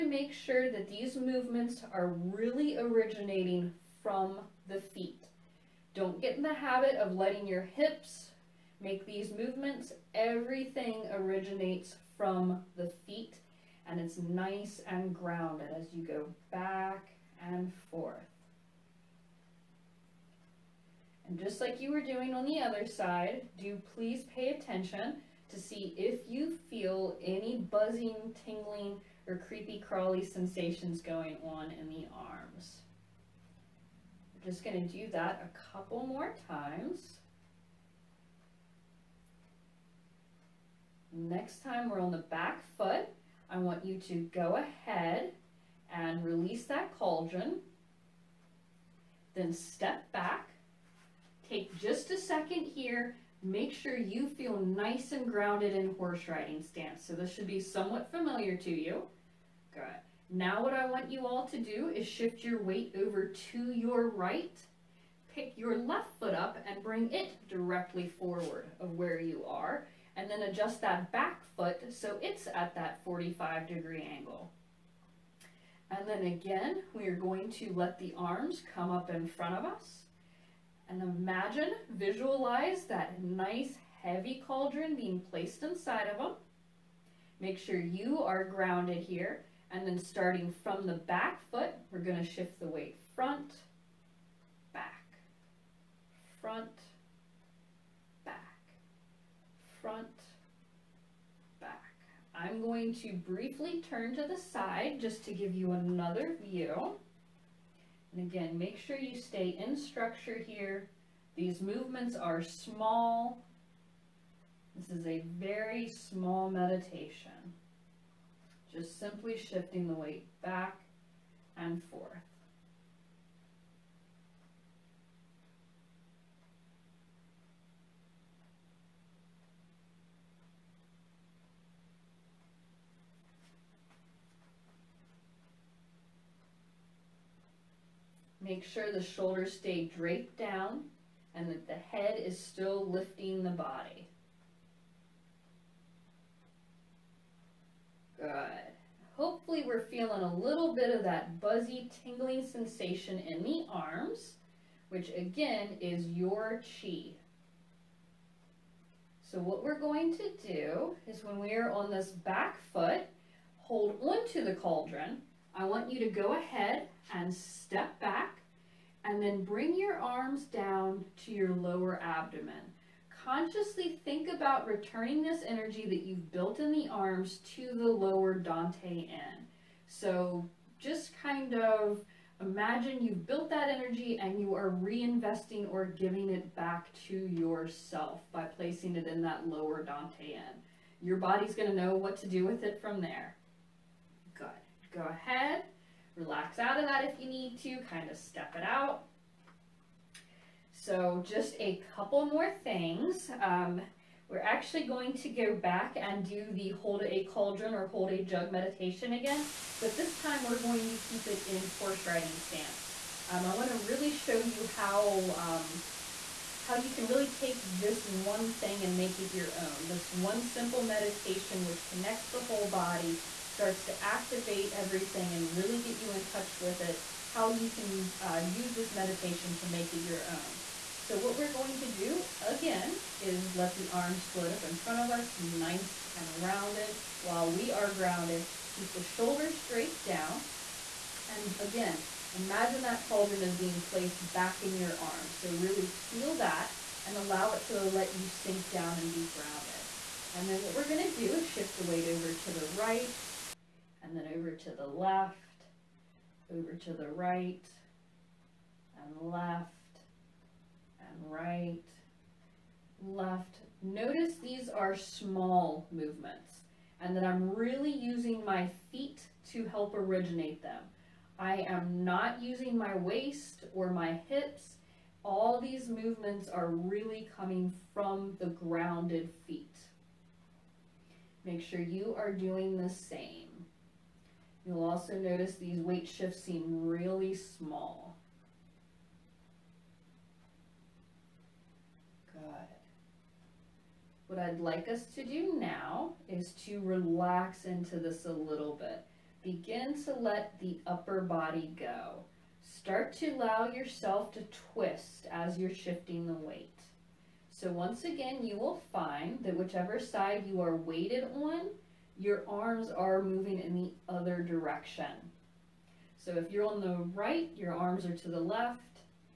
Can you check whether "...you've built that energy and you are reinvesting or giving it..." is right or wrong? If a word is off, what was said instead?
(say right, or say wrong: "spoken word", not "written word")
right.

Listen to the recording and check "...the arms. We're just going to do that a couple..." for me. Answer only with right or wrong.
right.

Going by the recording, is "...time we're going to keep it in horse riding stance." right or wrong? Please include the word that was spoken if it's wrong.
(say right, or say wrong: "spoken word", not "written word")
right.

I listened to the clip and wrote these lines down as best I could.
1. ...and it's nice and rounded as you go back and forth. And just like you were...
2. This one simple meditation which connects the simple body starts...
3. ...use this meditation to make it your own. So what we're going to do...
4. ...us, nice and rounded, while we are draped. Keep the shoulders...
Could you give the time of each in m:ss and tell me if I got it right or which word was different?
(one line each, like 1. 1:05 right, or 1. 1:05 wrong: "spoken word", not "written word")
1. 0:13 wrong: "grounded", not "rounded"
2. 3:39 wrong: "whole", not "simple"
3. 3:48 right
4. 3:55 wrong: "grounded", not "draped".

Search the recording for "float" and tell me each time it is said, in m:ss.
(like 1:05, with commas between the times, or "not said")
3:54.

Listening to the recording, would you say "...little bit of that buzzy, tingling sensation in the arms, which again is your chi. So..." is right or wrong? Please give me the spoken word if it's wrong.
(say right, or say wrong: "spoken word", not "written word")
right.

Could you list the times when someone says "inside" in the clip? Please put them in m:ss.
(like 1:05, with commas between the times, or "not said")
1:25.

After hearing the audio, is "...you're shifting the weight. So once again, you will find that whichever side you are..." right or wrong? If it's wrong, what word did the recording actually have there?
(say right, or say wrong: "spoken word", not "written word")
right.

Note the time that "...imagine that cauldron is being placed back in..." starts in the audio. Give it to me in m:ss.
4:02.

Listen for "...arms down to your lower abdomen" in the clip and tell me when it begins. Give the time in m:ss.
2:49.